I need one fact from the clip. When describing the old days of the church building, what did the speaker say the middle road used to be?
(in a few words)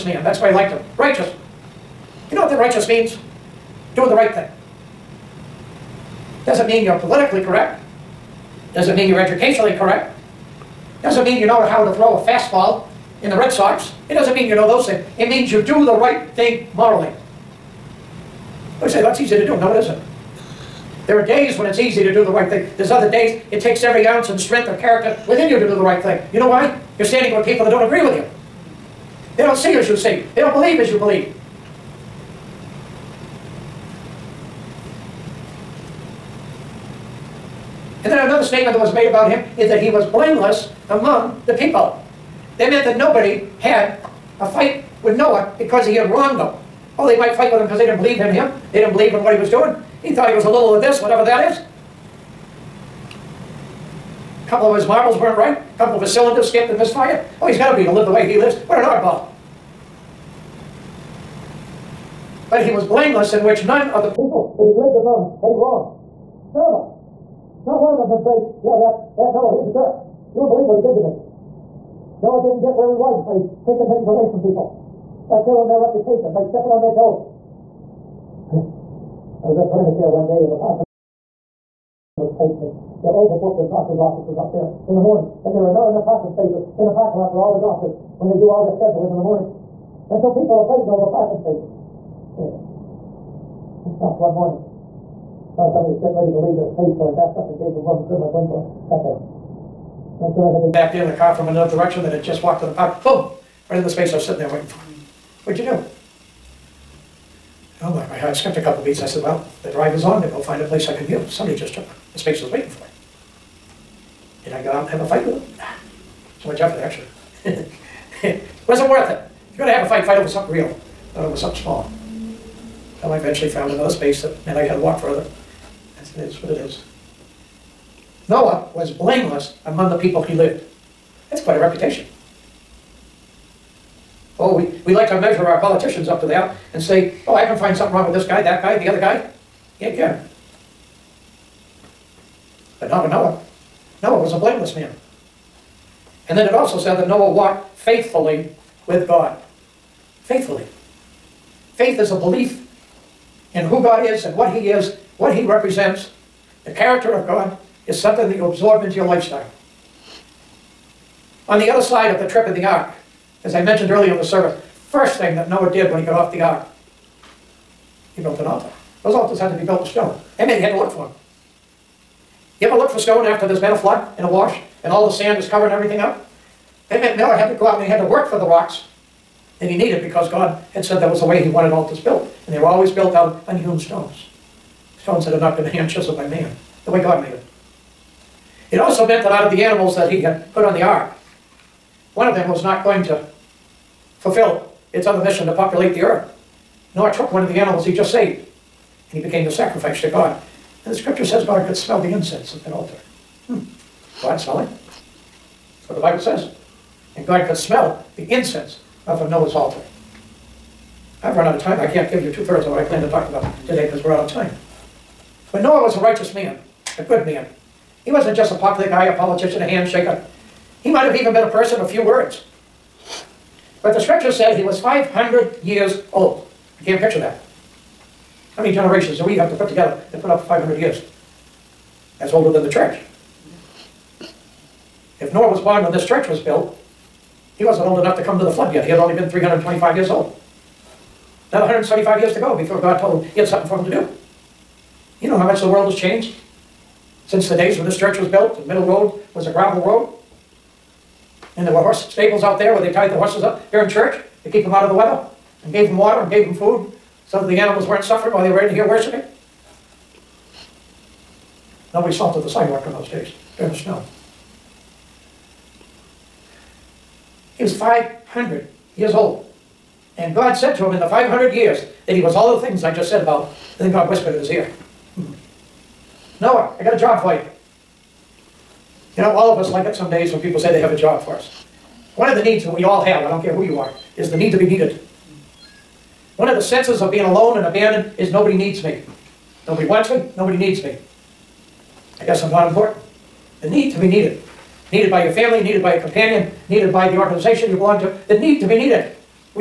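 a gravel road.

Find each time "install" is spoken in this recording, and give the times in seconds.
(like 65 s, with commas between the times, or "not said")
not said.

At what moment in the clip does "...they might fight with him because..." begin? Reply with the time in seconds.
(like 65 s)
47 s.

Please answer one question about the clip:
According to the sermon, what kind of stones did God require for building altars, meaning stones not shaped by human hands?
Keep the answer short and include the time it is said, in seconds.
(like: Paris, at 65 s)
unhewn stones, at 183 s.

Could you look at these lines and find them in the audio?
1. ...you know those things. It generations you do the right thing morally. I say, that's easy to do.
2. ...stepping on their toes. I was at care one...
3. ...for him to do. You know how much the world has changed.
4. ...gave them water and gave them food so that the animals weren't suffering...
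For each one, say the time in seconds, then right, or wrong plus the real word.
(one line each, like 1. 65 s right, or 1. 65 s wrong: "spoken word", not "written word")
1. 14 s wrong: "means", not "generations"
2. 76 s right
3. 243 s right
4. 255 s right.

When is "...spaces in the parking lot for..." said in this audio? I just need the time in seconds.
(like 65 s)
86 s.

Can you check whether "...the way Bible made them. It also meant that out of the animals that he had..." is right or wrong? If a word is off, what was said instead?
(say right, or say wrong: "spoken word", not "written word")
wrong: "God", not "Bible".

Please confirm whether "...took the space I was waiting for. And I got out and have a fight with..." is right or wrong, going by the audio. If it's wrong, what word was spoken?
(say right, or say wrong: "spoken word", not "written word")
right.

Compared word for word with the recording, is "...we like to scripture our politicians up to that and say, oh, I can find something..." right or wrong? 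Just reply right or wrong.
wrong.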